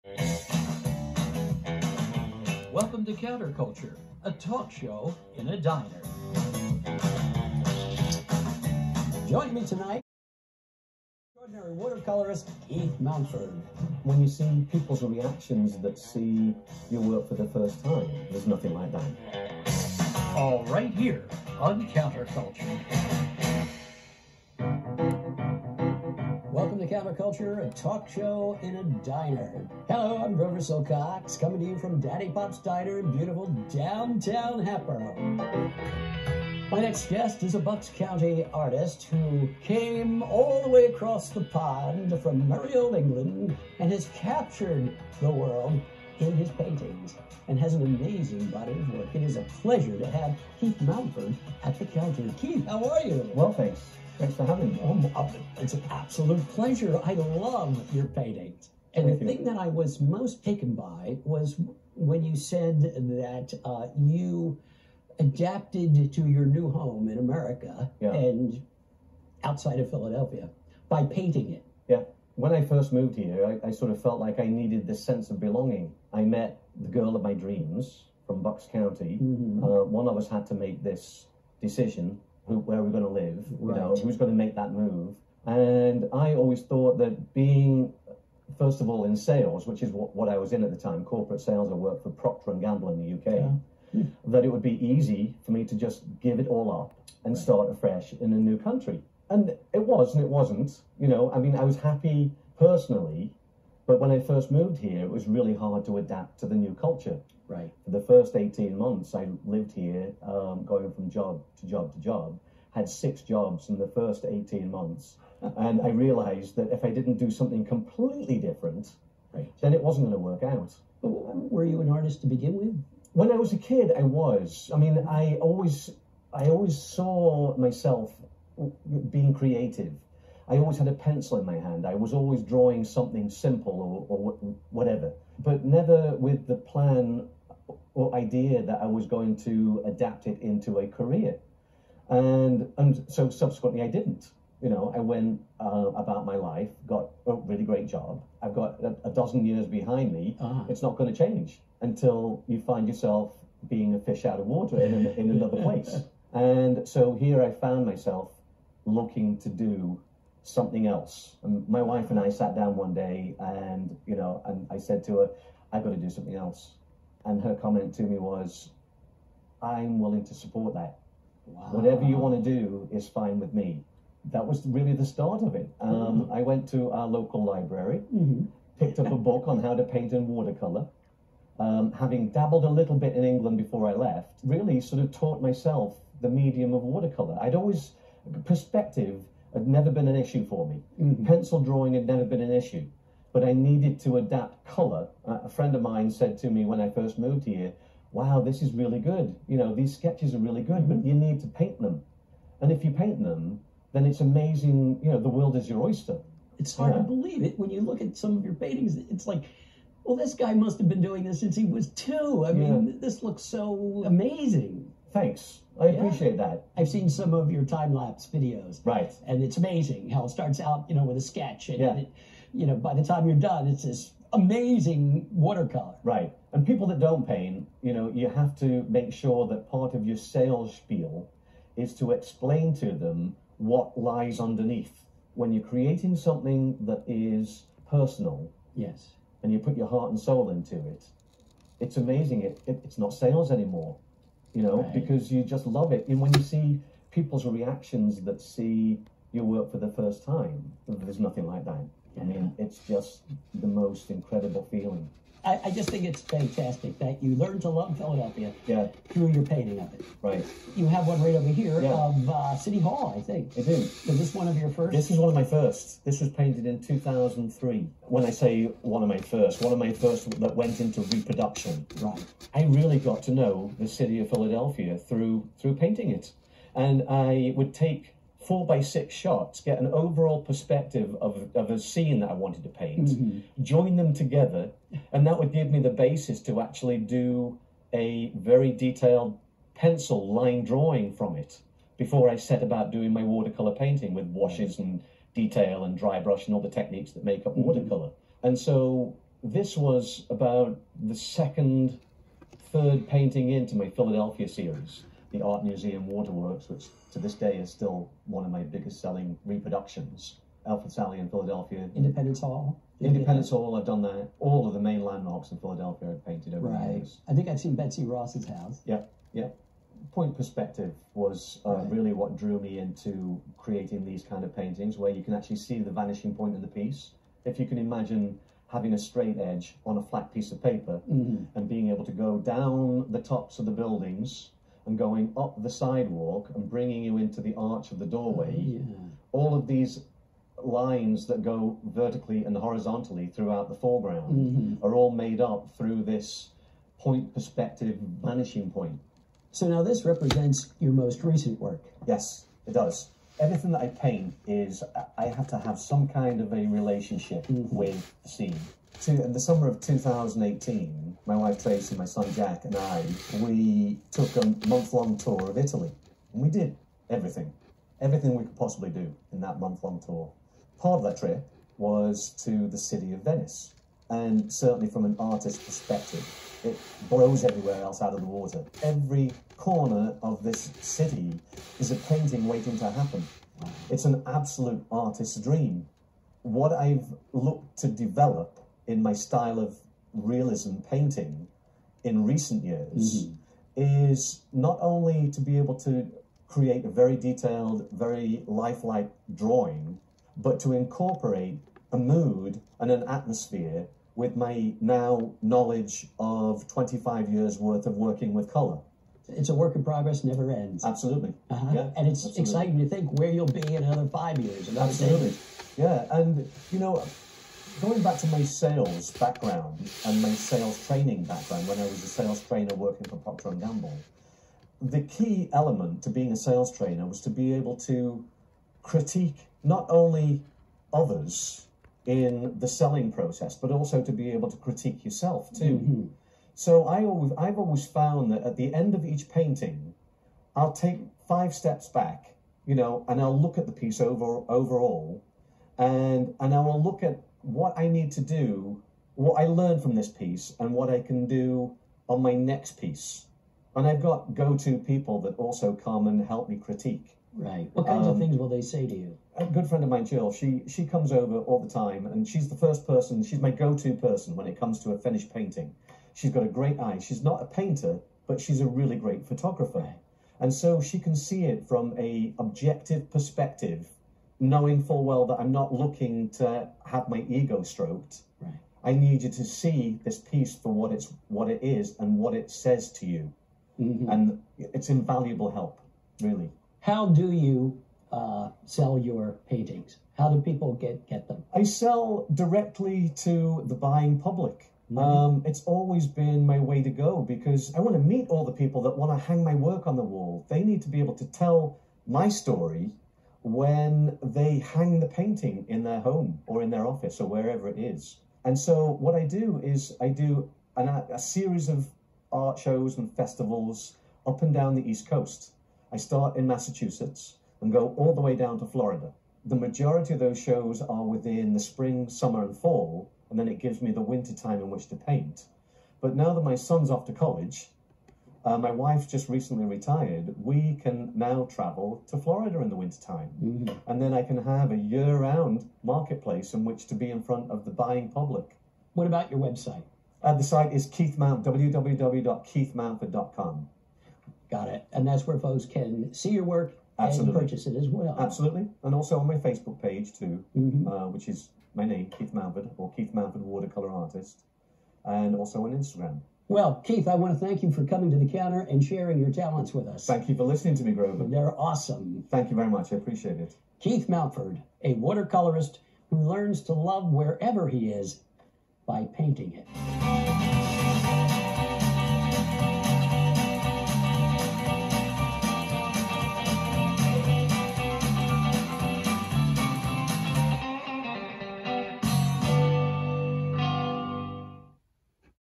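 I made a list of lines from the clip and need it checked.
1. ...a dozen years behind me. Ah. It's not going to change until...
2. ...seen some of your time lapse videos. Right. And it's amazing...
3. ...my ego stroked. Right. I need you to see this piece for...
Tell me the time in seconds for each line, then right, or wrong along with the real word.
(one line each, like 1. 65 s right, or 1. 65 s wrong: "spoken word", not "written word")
1. 149 s right
2. 216 s right
3. 477 s right.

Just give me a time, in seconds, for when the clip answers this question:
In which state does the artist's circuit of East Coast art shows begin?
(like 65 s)
516 s.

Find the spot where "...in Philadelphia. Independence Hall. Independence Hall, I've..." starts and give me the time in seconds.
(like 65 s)
311 s.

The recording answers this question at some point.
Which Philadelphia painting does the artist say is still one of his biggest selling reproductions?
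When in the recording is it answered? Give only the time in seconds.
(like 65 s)
305 s.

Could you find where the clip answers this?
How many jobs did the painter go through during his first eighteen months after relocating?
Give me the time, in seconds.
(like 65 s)
112 s.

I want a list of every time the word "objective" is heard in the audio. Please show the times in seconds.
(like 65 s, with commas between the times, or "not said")
472 s.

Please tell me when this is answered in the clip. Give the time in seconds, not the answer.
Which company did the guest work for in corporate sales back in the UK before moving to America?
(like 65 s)
92 s.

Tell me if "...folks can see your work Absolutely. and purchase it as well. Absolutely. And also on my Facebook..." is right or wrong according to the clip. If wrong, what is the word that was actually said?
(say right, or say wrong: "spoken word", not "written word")
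right.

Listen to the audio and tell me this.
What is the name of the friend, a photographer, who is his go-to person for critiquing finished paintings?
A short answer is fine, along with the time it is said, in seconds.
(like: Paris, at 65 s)
Jill, at 460 s.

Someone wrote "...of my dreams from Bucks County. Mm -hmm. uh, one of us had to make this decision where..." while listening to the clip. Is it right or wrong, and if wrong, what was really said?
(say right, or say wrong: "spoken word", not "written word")
right.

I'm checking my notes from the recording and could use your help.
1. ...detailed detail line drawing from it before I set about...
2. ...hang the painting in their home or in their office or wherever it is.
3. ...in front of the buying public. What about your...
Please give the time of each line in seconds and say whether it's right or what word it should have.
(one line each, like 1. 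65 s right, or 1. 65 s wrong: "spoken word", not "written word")
1. 288 s wrong: "pencil", not "detail"
2. 504 s right
3. 537 s right.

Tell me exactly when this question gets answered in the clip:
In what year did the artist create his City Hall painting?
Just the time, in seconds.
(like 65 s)
266 s.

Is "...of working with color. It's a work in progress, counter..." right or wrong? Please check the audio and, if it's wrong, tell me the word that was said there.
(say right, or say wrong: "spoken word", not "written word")
wrong: "never", not "counter".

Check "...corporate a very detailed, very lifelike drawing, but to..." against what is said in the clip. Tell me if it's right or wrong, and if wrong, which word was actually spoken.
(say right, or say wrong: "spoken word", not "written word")
wrong: "create", not "corporate".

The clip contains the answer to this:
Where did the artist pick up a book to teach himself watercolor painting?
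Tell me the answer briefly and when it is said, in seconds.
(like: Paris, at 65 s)
local library, at 177 s.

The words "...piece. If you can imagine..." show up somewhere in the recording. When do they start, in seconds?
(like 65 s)
326 s.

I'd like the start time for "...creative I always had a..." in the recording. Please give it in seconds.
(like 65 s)
129 s.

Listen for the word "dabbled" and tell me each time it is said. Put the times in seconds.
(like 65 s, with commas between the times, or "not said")
182 s.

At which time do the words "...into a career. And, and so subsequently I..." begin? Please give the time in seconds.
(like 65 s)
140 s.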